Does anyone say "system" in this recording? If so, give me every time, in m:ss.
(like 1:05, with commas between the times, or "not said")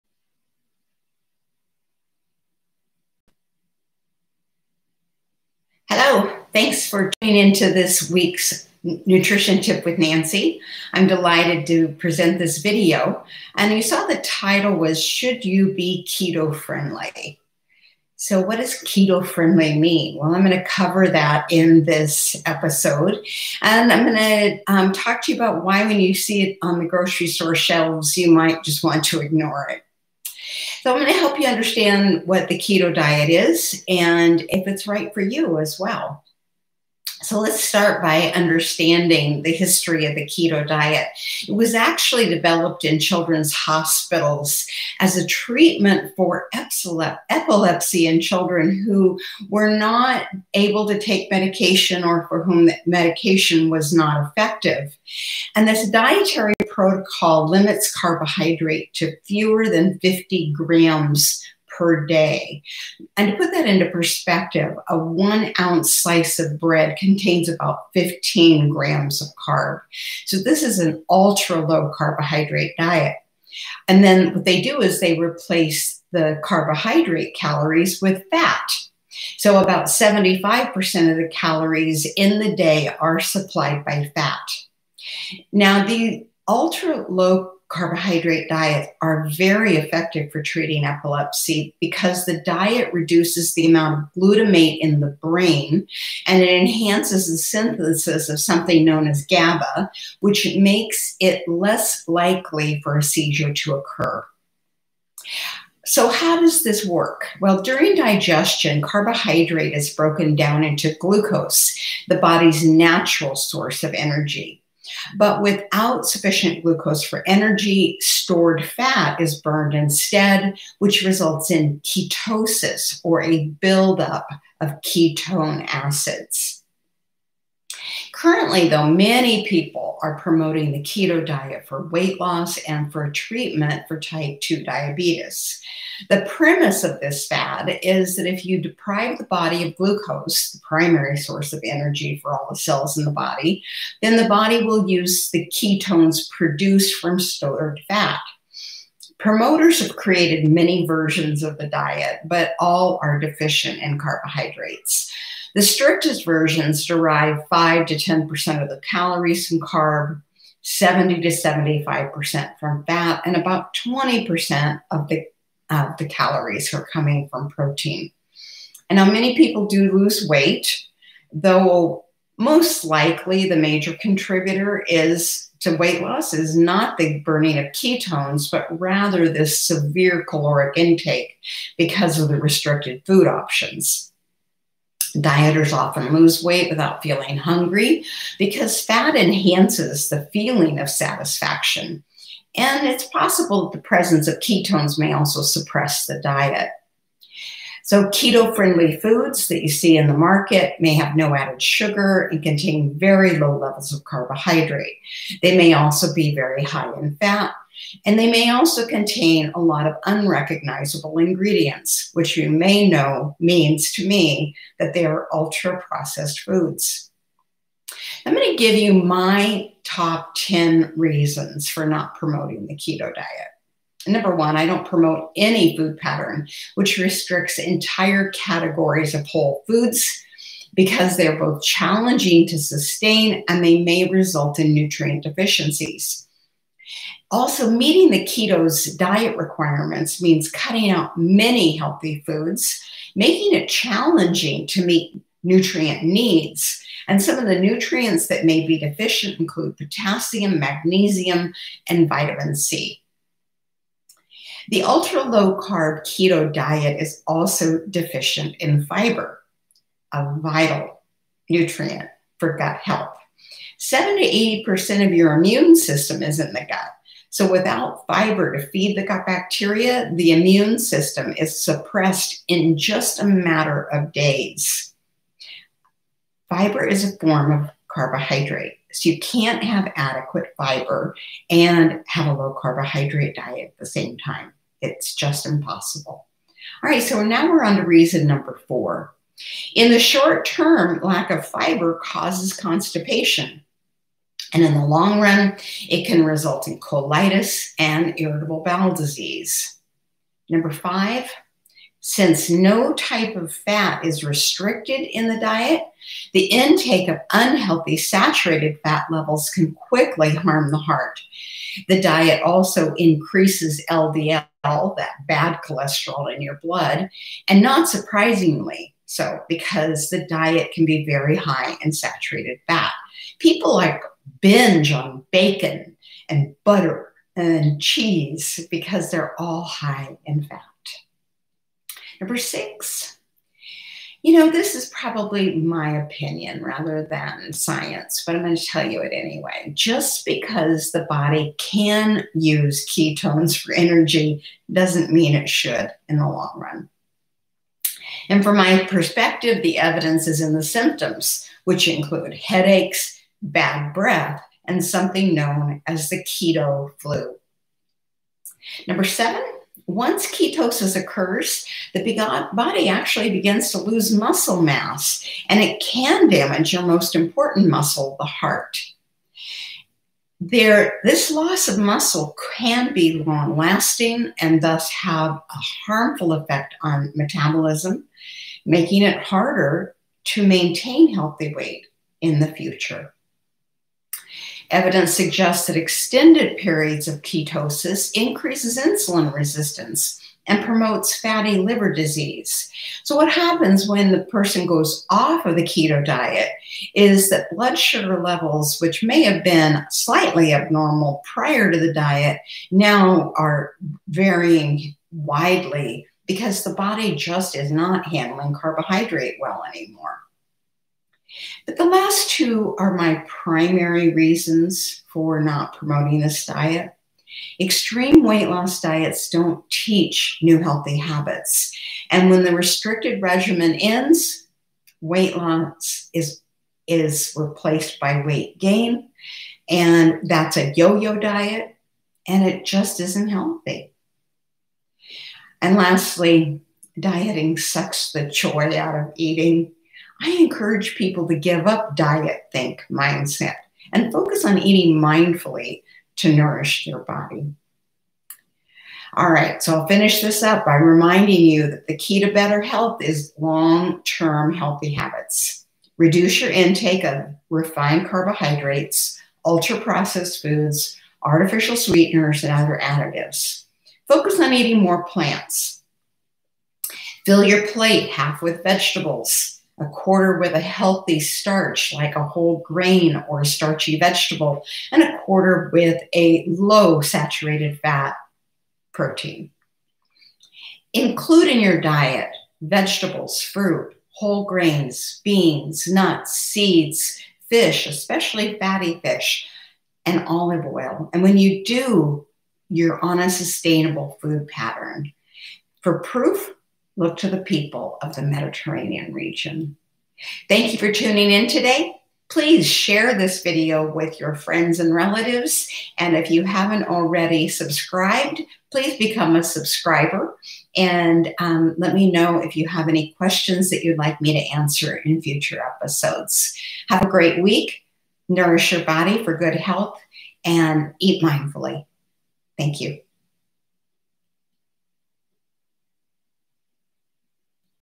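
4:25, 4:30.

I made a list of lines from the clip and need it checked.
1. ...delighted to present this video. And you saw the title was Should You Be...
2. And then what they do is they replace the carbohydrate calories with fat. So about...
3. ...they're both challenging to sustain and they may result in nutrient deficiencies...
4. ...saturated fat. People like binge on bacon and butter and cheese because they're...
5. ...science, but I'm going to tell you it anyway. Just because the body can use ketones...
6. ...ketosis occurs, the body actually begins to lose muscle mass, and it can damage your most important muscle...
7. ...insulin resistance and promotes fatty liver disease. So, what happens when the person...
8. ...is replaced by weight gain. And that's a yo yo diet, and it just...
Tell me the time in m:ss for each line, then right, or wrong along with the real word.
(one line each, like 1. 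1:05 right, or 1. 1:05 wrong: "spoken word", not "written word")
1. 0:11 right
2. 1:13 right
3. 3:51 right
4. 5:21 right
5. 5:37 right
6. 6:00 right
7. 6:28 right
8. 7:06 right.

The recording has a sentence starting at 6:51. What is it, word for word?
But the last two are my primary reasons for not promoting this diet.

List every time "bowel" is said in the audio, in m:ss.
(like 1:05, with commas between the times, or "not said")
4:58.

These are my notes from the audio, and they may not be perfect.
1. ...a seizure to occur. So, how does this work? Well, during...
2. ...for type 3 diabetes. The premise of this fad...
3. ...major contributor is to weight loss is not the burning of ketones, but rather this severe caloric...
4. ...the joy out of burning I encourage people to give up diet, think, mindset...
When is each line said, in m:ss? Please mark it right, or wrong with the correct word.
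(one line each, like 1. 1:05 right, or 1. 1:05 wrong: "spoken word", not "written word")
1. 1:42 right
2. 2:13 wrong: "2", not "3"
3. 2:53 right
4. 7:18 wrong: "eating", not "burning".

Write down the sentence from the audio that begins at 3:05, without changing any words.
Dieters often lose weight without feeling hungry because fat enhances the feeling of satisfaction.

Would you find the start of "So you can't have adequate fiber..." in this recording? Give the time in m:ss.
4:38.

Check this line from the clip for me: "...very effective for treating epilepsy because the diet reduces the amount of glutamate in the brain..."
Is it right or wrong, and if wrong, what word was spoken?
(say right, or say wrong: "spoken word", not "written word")
right.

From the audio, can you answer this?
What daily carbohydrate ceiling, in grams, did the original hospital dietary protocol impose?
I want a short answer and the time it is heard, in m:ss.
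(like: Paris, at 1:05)
fewer than 50 grams, at 0:59.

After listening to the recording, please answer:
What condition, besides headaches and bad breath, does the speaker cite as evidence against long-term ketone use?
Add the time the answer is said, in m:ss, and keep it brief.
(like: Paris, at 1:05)
keto flu, at 5:56.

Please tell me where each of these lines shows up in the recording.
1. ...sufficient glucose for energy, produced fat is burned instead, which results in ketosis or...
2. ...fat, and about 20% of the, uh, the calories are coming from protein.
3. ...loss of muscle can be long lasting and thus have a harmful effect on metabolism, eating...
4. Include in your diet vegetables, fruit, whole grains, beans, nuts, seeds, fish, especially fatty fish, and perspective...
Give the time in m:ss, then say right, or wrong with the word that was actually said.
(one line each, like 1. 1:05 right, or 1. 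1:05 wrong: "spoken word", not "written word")
1. 1:56 wrong: "stored", not "produced"
2. 2:42 right
3. 6:11 wrong: "making", not "eating"
4. 8:00 wrong: "olive", not "perspective".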